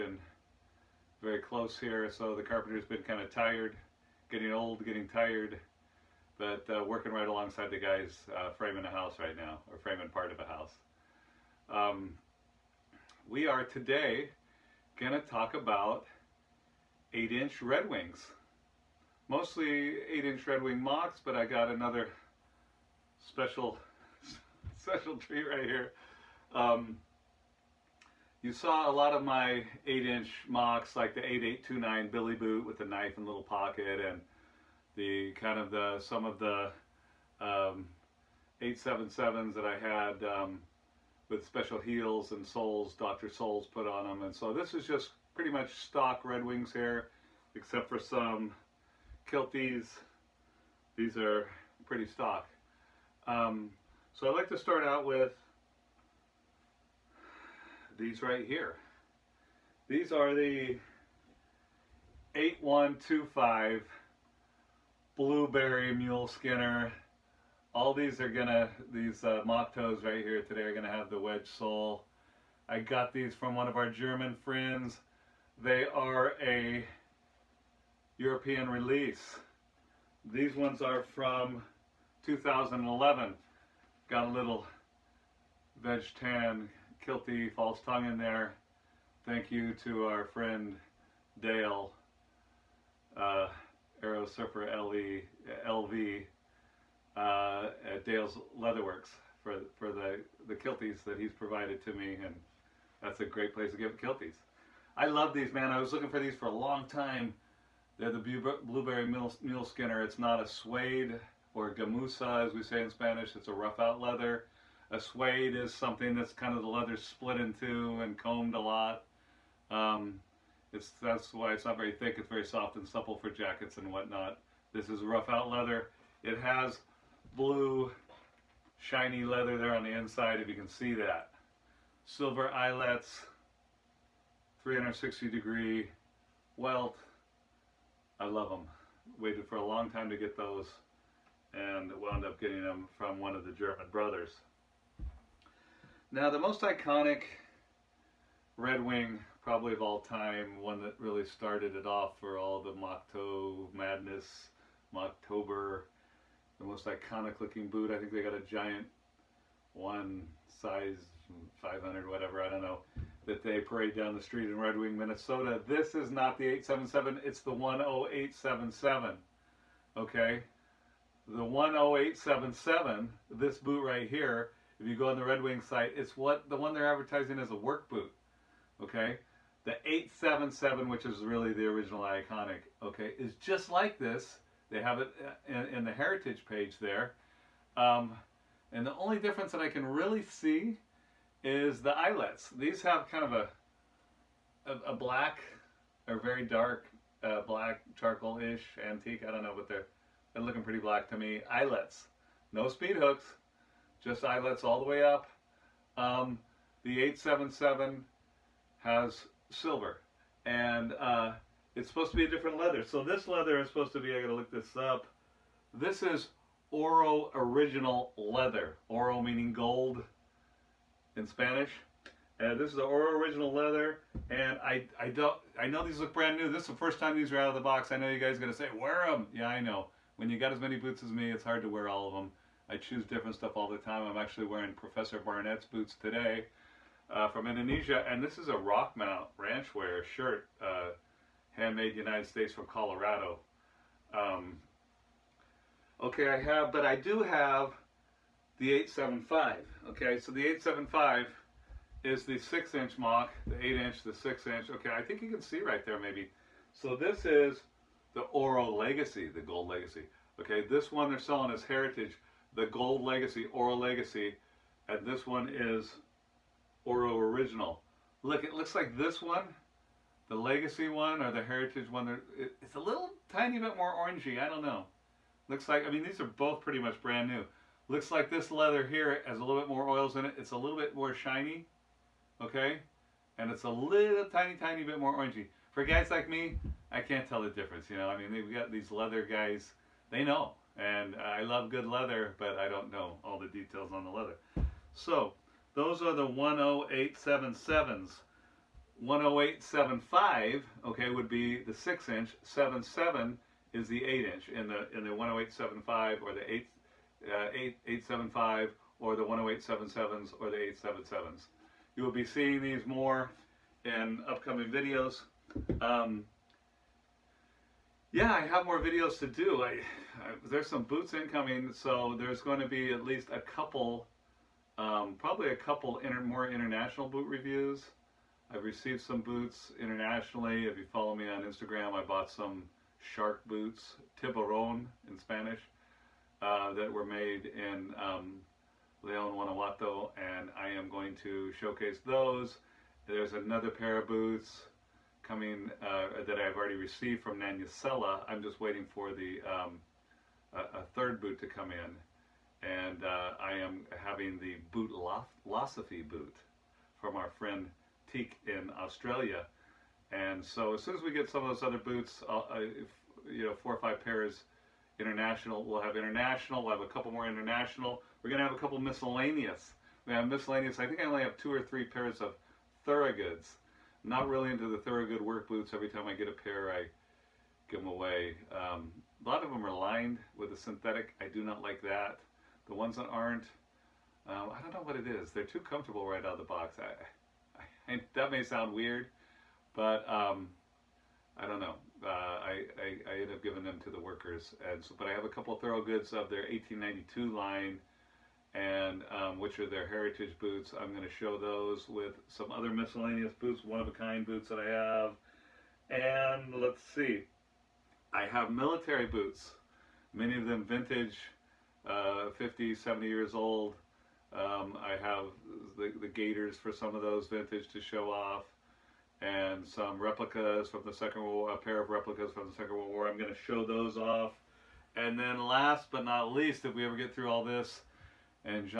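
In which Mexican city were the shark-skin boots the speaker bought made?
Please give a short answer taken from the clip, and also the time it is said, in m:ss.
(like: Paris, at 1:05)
Leon Guanajuato, at 5:39.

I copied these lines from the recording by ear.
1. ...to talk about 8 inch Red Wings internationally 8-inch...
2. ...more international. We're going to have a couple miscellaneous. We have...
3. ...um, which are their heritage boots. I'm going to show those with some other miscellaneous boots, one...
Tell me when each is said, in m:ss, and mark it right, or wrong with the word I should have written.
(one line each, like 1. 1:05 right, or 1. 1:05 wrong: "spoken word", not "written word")
1. 0:15 wrong: "mostly", not "internationally"
2. 6:07 right
3. 6:39 right.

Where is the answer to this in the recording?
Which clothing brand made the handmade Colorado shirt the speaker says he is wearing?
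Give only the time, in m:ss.
3:58.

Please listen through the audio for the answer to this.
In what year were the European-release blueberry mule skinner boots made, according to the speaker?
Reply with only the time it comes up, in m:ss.
1:22.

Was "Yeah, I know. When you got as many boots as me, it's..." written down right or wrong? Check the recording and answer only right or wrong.
right.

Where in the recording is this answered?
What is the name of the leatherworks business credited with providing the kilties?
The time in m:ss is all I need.
1:38.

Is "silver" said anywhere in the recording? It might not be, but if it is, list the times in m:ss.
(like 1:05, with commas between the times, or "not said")
2:12, 3:29.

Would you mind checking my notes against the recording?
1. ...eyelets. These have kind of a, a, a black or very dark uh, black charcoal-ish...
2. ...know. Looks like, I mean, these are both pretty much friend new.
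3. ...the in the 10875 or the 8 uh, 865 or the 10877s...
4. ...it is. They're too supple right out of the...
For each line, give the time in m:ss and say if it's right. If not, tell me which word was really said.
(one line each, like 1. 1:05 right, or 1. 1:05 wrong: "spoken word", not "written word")
1. 3:11 right
2. 4:34 wrong: "brand", not "friend"
3. 5:04 wrong: "875", not "865"
4. 6:24 wrong: "comfortable", not "supple".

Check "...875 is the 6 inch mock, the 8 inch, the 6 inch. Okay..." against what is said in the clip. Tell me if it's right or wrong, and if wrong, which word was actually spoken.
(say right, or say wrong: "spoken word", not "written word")
right.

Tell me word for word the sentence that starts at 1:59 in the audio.
Um, it's, that's why it's not very thick.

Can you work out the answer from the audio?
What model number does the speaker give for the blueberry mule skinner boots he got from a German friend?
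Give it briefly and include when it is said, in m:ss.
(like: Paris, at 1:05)
8125, at 1:02.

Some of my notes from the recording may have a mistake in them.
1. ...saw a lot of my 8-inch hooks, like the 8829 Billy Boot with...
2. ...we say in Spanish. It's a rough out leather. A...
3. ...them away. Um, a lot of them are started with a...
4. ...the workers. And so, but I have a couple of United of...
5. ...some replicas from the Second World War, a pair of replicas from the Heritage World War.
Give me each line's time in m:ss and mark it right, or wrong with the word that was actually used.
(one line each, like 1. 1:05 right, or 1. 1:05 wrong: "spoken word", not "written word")
1. 0:28 wrong: "mocks", not "hooks"
2. 1:52 right
3. 6:17 wrong: "lined", not "started"
4. 6:33 wrong: "Thorogoods", not "United"
5. 6:59 wrong: "Second", not "Heritage".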